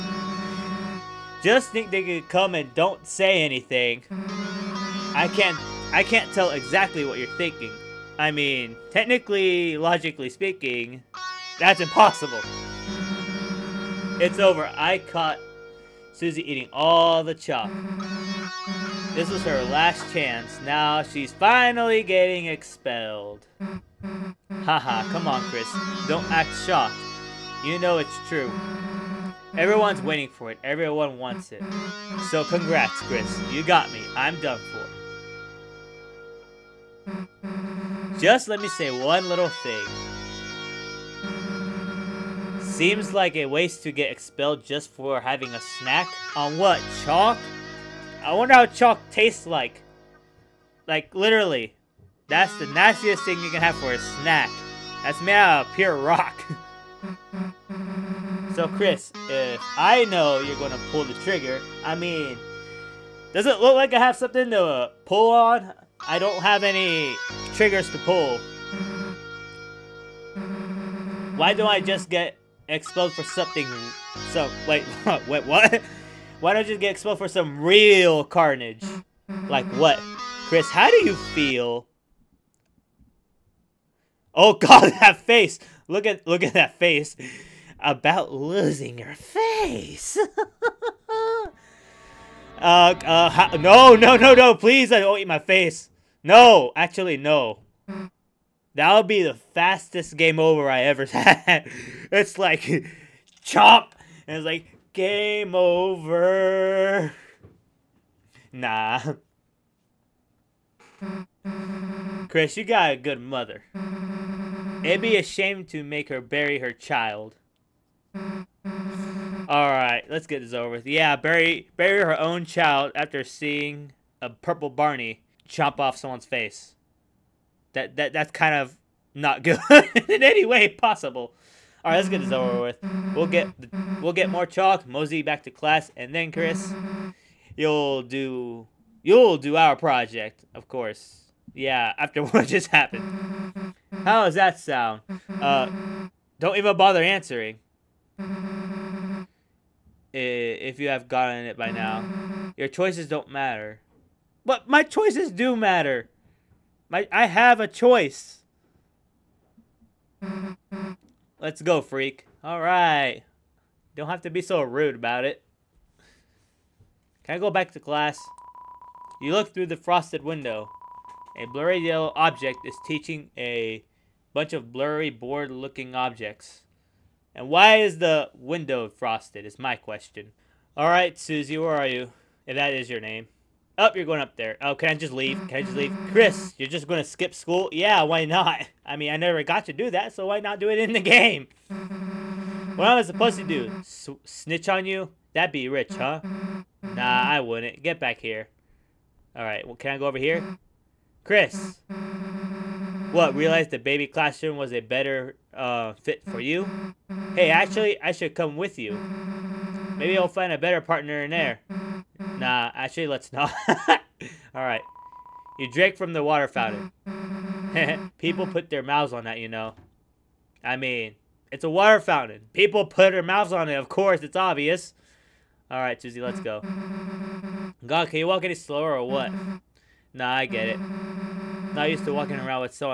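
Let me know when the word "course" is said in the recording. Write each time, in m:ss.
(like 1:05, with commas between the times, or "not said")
2:20, 3:43.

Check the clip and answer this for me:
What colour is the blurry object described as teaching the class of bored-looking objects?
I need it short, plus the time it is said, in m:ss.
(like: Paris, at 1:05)
yellow, at 2:51.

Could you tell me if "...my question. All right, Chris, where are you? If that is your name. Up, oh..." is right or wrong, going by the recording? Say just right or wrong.
wrong.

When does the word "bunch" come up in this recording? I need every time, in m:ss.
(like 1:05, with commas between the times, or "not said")
2:54.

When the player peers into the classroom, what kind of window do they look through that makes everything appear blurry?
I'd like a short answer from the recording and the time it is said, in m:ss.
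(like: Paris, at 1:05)
frosted window, at 2:49.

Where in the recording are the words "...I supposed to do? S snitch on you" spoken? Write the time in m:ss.
3:12.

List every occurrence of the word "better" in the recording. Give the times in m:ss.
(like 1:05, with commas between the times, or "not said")
3:24, 3:30.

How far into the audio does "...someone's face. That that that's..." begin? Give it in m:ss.
2:05.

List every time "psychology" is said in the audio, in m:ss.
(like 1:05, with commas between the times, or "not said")
not said.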